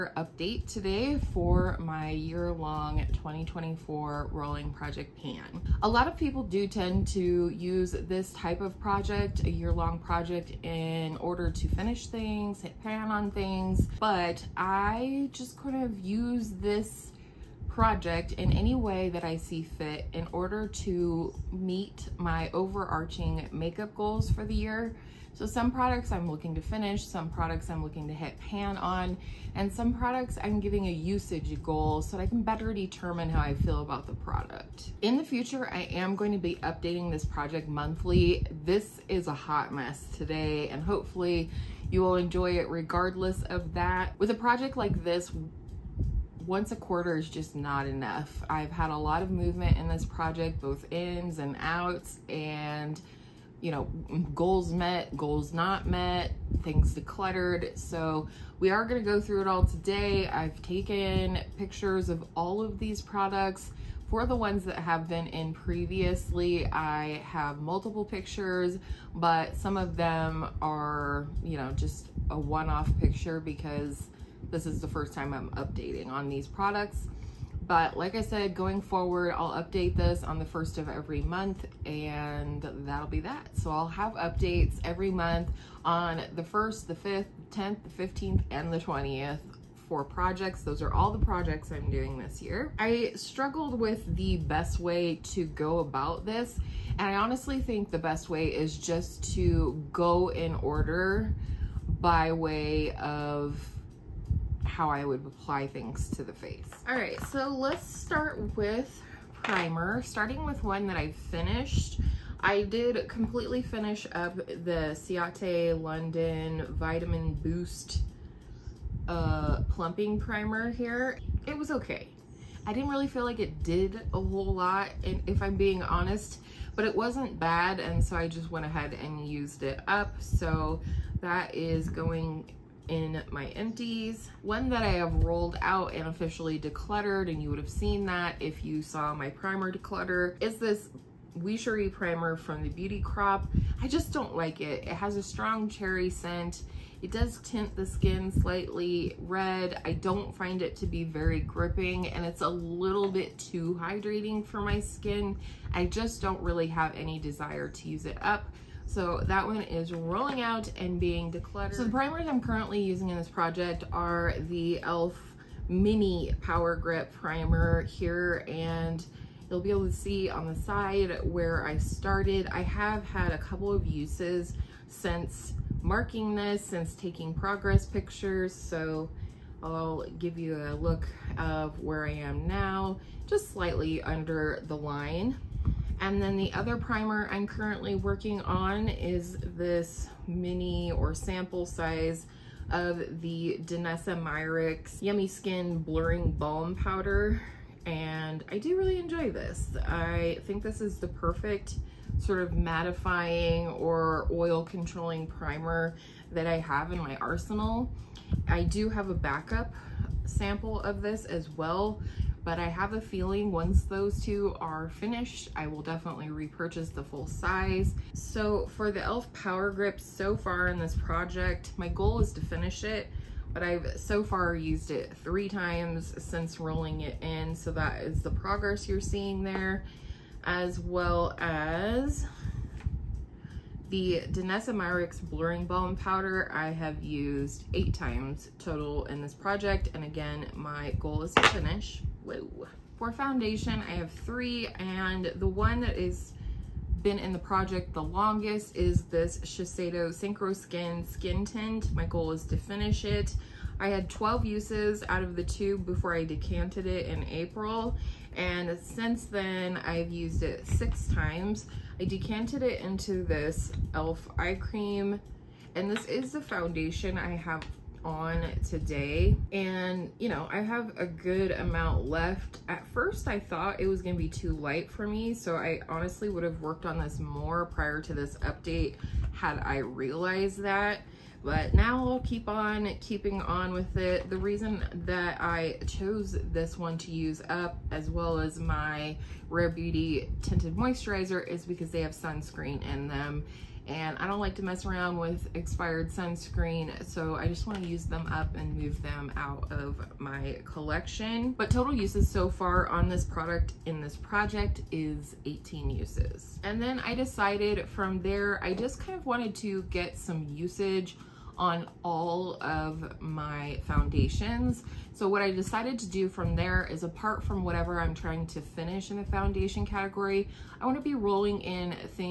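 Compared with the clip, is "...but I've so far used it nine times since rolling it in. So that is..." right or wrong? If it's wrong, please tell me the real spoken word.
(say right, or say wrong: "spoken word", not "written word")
wrong: "three", not "nine".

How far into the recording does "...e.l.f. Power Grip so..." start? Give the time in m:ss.
3:38.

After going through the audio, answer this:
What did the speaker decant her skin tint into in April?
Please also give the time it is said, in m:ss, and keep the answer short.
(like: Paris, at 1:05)
e.l.f. eye cream, at 4:23.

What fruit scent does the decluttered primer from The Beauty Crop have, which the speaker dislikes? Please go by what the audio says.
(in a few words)
Cherry.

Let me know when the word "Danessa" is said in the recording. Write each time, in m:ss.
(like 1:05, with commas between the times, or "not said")
3:13, 3:54.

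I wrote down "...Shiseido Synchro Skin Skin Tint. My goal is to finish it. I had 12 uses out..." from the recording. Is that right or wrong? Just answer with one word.
right.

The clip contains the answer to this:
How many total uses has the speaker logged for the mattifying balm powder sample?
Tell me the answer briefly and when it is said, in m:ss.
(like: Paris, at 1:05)
8, at 3:57.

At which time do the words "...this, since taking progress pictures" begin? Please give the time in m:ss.
2:56.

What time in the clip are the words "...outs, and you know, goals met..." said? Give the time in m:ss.
0:51.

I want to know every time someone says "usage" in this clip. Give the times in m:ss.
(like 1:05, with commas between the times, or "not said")
0:30, 5:10.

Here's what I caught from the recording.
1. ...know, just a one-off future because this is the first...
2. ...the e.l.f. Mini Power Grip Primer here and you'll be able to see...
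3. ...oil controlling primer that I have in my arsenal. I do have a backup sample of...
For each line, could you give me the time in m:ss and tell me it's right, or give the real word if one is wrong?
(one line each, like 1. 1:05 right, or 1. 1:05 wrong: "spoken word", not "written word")
1. 1:11 wrong: "picture", not "future"
2. 2:44 right
3. 3:24 right.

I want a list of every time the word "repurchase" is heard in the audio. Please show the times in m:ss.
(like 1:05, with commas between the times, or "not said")
3:36.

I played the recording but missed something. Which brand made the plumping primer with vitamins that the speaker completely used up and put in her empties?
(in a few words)
Ciate London.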